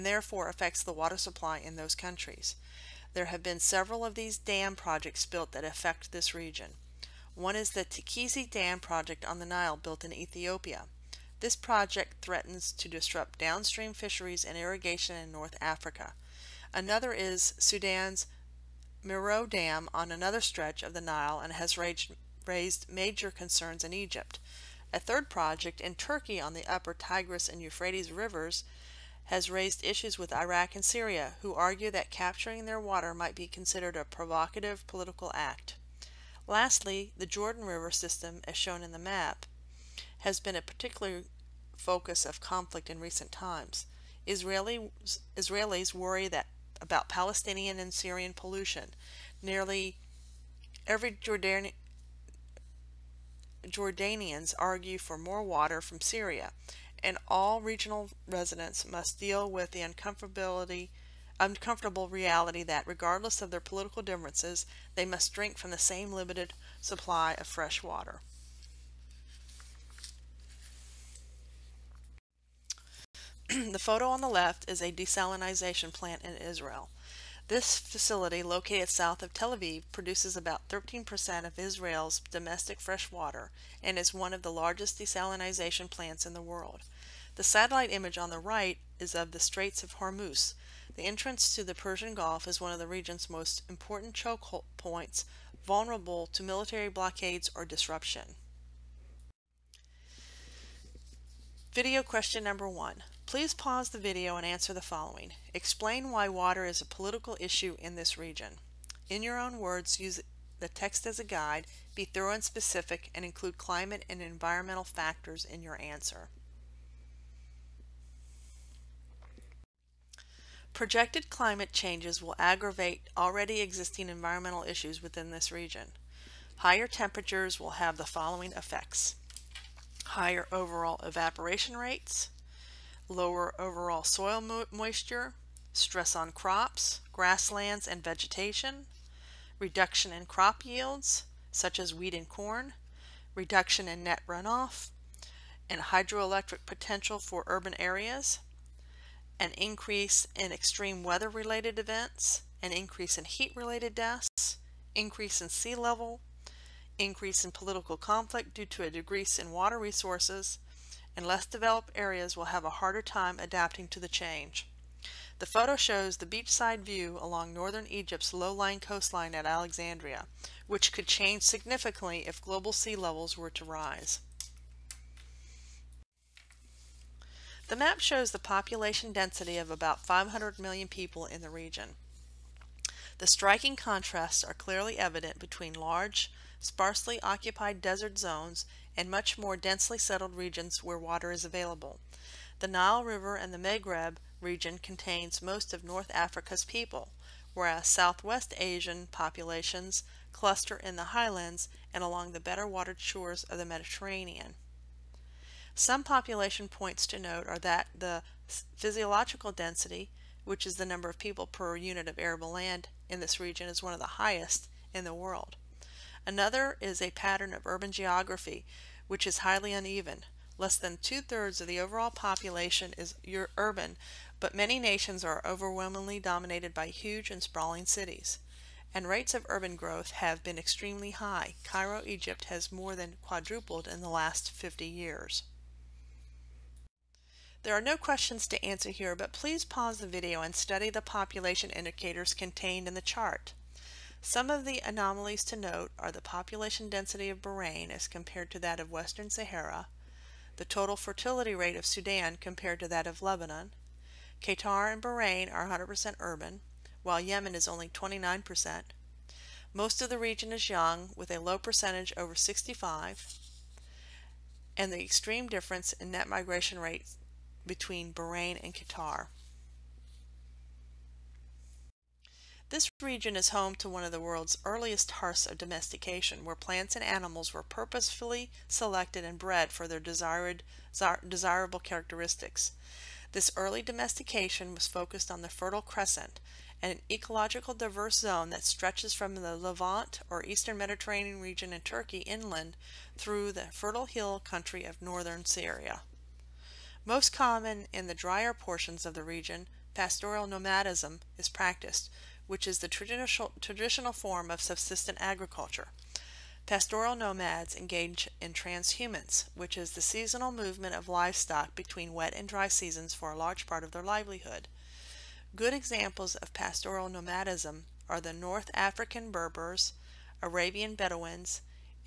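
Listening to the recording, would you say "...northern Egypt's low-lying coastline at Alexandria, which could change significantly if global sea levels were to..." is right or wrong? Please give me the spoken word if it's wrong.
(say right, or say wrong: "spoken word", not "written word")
right.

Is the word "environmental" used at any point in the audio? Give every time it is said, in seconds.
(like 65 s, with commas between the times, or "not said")
114 s, 124 s.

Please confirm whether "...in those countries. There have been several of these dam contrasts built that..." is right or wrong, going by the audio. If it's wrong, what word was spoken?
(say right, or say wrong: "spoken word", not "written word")
wrong: "projects", not "contrasts".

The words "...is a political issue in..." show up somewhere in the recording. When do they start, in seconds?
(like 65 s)
106 s.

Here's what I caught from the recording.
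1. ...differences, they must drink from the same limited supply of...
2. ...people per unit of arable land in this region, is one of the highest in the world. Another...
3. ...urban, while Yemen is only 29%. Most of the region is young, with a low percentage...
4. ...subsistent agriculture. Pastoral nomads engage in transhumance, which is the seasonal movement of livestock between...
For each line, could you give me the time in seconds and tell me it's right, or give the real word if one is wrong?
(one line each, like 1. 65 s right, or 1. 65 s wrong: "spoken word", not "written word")
1. 64 s right
2. 211 s right
3. 256 s right
4. 304 s right.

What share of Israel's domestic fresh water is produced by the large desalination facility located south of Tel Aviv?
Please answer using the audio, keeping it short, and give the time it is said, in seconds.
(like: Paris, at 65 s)
13%, at 80 s.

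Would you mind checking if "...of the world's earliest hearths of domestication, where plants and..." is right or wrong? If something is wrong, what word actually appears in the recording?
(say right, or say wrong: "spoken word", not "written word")
right.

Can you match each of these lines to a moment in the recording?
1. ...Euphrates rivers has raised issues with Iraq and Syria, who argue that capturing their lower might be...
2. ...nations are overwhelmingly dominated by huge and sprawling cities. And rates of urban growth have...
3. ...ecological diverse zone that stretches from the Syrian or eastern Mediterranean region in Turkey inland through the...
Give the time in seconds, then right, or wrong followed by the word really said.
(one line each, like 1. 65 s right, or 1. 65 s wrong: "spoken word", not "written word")
1. 27 s wrong: "water", not "lower"
2. 224 s right
3. 287 s wrong: "Levant", not "Syrian".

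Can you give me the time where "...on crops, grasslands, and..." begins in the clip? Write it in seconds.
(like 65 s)
136 s.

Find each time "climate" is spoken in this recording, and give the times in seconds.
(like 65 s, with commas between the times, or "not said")
113 s, 121 s.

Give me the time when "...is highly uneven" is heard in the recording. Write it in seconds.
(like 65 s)
219 s.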